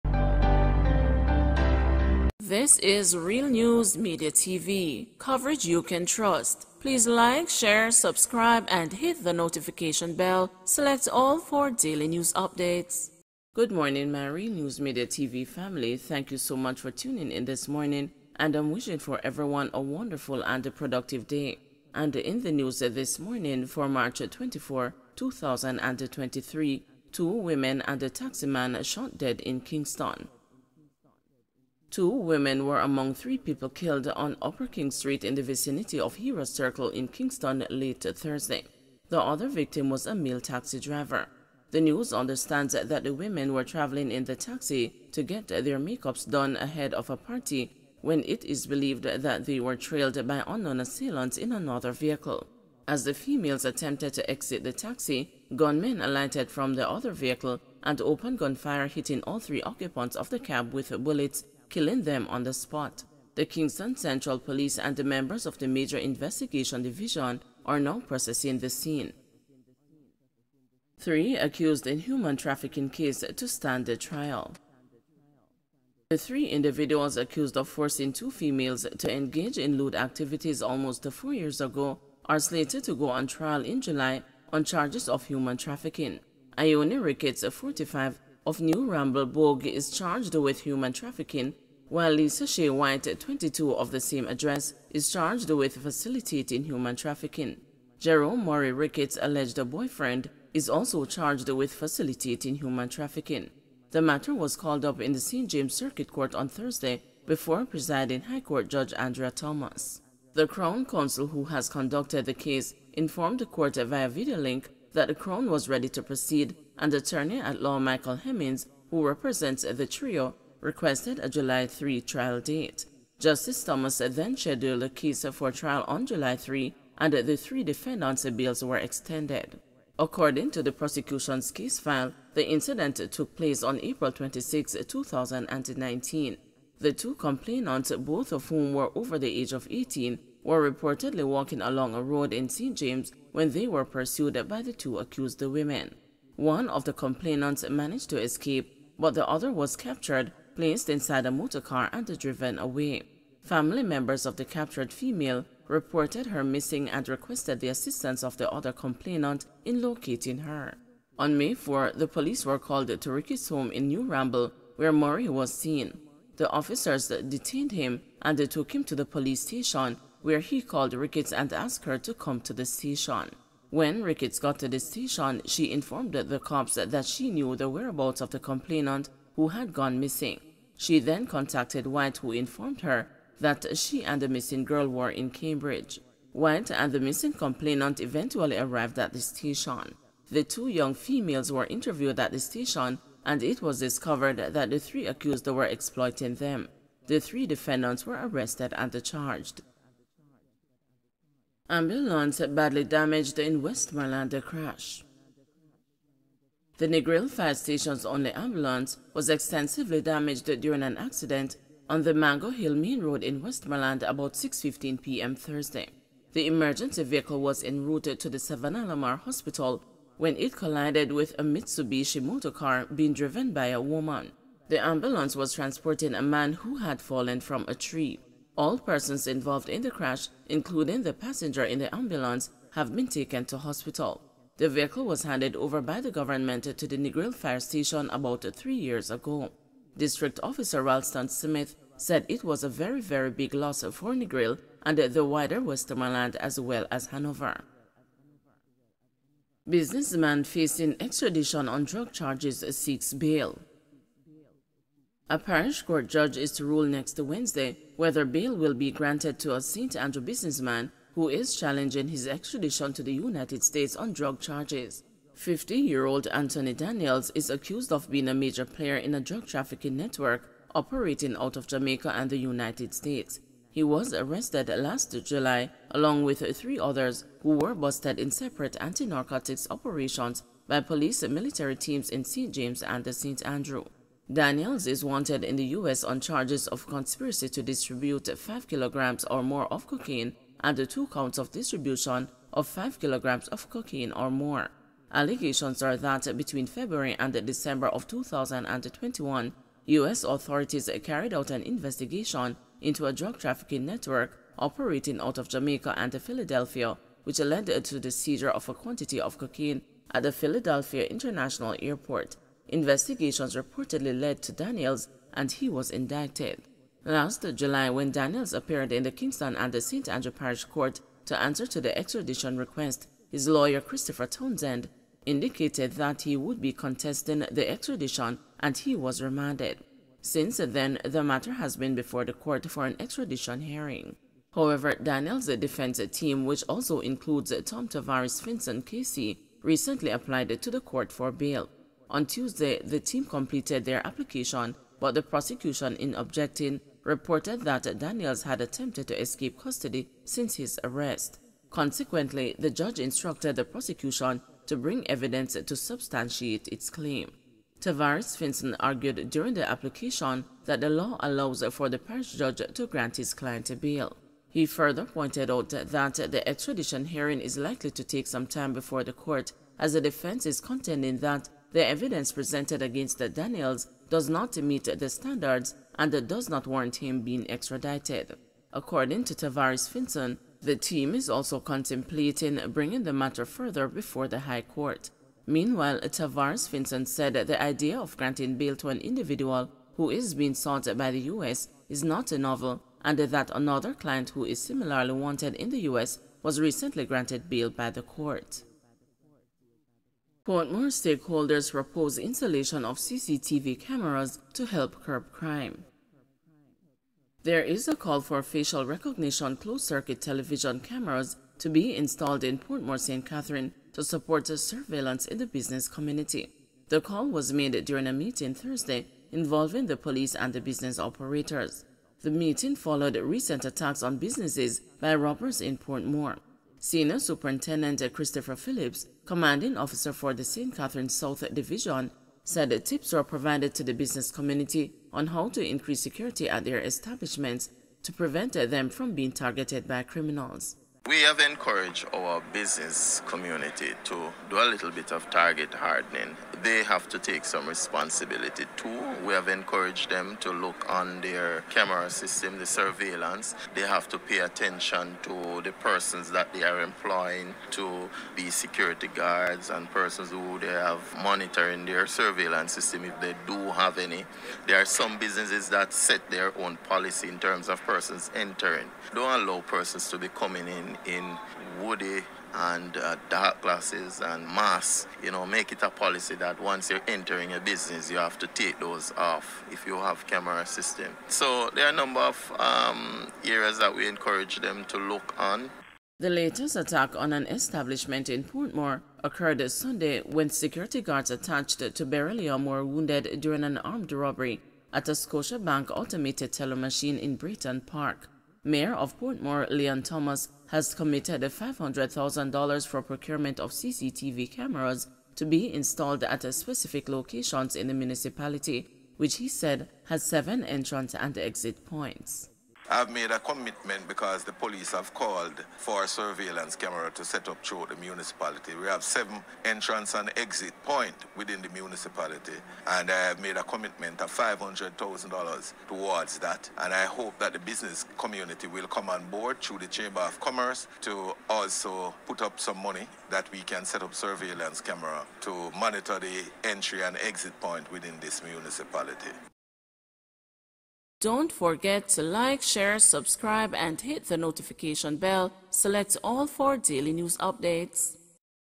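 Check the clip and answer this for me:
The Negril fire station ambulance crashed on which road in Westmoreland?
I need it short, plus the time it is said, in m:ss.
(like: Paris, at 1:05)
Mango Hill Main Road, at 3:32.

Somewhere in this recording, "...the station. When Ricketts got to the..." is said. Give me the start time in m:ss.
2:52.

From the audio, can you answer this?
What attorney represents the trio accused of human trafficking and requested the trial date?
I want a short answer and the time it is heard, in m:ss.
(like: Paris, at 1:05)
Michael Hemmings, at 1:57.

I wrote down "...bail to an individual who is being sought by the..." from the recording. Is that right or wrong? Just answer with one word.
right.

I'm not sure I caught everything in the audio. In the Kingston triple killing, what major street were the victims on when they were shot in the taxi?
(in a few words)
Upper King Street.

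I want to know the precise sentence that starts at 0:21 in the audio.
And in the news this morning for March 24, 2023, two women and a taxi man shot dead in Kingston.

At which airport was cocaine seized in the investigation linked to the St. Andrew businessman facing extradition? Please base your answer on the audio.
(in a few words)
Philadelphia International Airport.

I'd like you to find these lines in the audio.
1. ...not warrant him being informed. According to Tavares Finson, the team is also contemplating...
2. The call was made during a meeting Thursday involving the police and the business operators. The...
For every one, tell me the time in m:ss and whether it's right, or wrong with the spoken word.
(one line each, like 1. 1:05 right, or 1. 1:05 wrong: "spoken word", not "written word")
1. 6:16 wrong: "extradited", not "informed"
2. 6:56 right.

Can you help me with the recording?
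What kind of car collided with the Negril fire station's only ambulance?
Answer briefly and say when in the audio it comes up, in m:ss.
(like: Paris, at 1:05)
Mitsubishi, at 3:41.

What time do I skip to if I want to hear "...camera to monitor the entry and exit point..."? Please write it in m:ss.
8:54.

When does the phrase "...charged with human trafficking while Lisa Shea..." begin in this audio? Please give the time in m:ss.
1:29.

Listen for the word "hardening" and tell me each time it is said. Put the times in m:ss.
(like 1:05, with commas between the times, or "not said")
7:25.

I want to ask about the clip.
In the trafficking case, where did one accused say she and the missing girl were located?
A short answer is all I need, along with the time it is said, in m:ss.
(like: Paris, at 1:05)
Cambridge, at 3:05.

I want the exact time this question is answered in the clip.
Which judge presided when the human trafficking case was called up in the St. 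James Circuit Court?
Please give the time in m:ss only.
1:48.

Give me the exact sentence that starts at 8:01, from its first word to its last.
So there are a number of um, areas that we encourage them to look on.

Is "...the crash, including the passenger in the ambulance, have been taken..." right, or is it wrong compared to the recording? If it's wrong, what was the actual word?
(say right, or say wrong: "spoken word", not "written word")
right.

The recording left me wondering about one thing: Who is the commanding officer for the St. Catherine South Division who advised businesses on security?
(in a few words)
Christopher Phillips.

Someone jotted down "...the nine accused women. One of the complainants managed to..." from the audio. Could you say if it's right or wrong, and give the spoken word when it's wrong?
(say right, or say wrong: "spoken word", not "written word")
wrong: "two", not "nine".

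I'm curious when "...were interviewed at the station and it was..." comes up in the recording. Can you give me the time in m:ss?
3:11.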